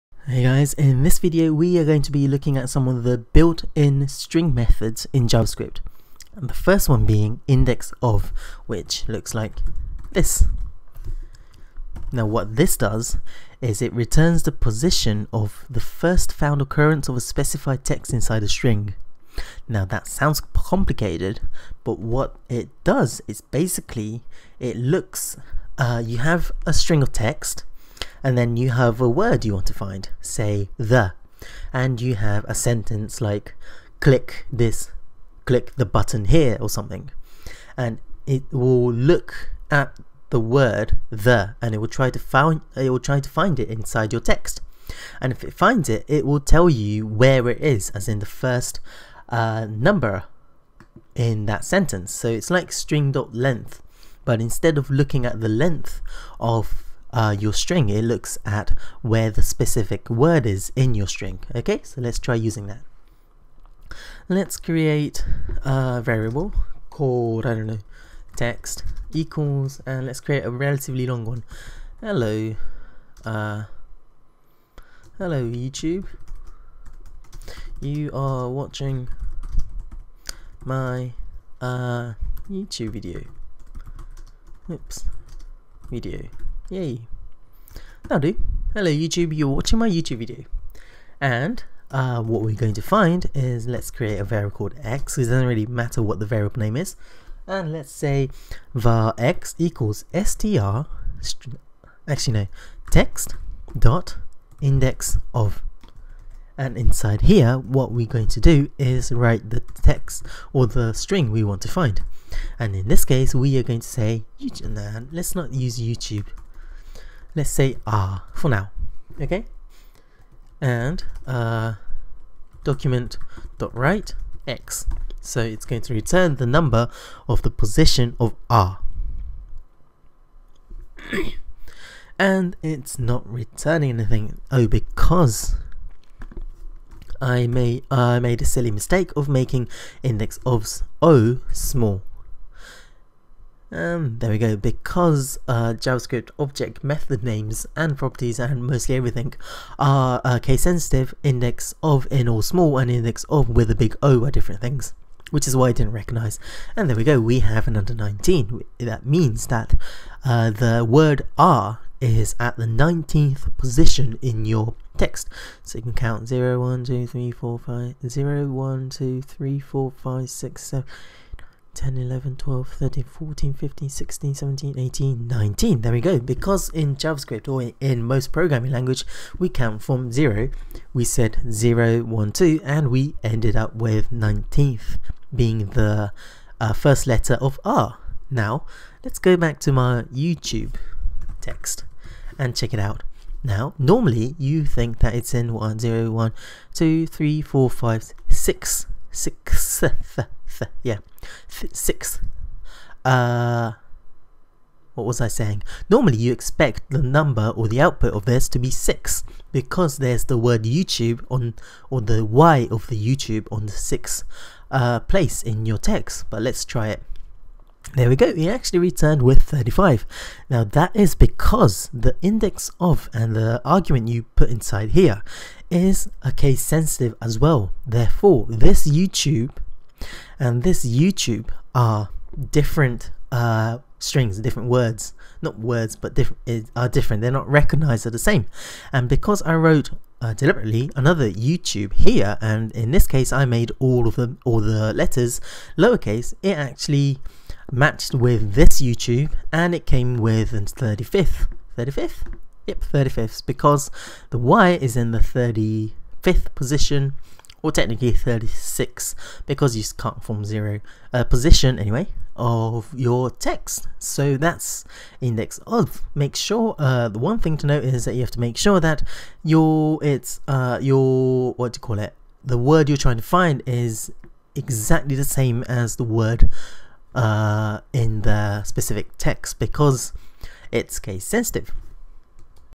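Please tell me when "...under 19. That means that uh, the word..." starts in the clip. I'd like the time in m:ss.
2:37.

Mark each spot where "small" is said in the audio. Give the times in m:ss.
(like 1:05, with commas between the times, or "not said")
2:21, 2:32.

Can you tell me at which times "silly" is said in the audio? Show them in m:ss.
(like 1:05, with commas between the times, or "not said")
2:18.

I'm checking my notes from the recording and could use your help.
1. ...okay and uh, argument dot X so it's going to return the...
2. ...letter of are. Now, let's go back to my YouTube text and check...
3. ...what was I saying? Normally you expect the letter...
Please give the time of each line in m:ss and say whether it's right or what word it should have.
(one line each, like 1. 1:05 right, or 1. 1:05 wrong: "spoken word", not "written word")
1. 1:59 wrong: "document", not "argument"
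2. 3:07 right
3. 3:24 wrong: "number", not "letter".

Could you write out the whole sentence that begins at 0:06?
And the first one being index of, which looks like this.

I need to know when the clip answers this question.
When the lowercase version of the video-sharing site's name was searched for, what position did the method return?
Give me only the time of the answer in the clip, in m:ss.
3:39.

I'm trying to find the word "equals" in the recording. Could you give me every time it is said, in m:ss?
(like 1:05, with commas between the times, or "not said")
1:09, 1:39.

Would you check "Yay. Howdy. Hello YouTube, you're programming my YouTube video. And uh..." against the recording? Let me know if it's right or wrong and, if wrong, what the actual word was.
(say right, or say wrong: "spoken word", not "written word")
wrong: "watching", not "programming".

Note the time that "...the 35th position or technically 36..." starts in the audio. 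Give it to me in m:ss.
4:15.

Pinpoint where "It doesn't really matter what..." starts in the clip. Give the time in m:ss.
1:35.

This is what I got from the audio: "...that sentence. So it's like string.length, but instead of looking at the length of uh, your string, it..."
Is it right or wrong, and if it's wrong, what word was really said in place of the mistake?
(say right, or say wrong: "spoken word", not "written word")
right.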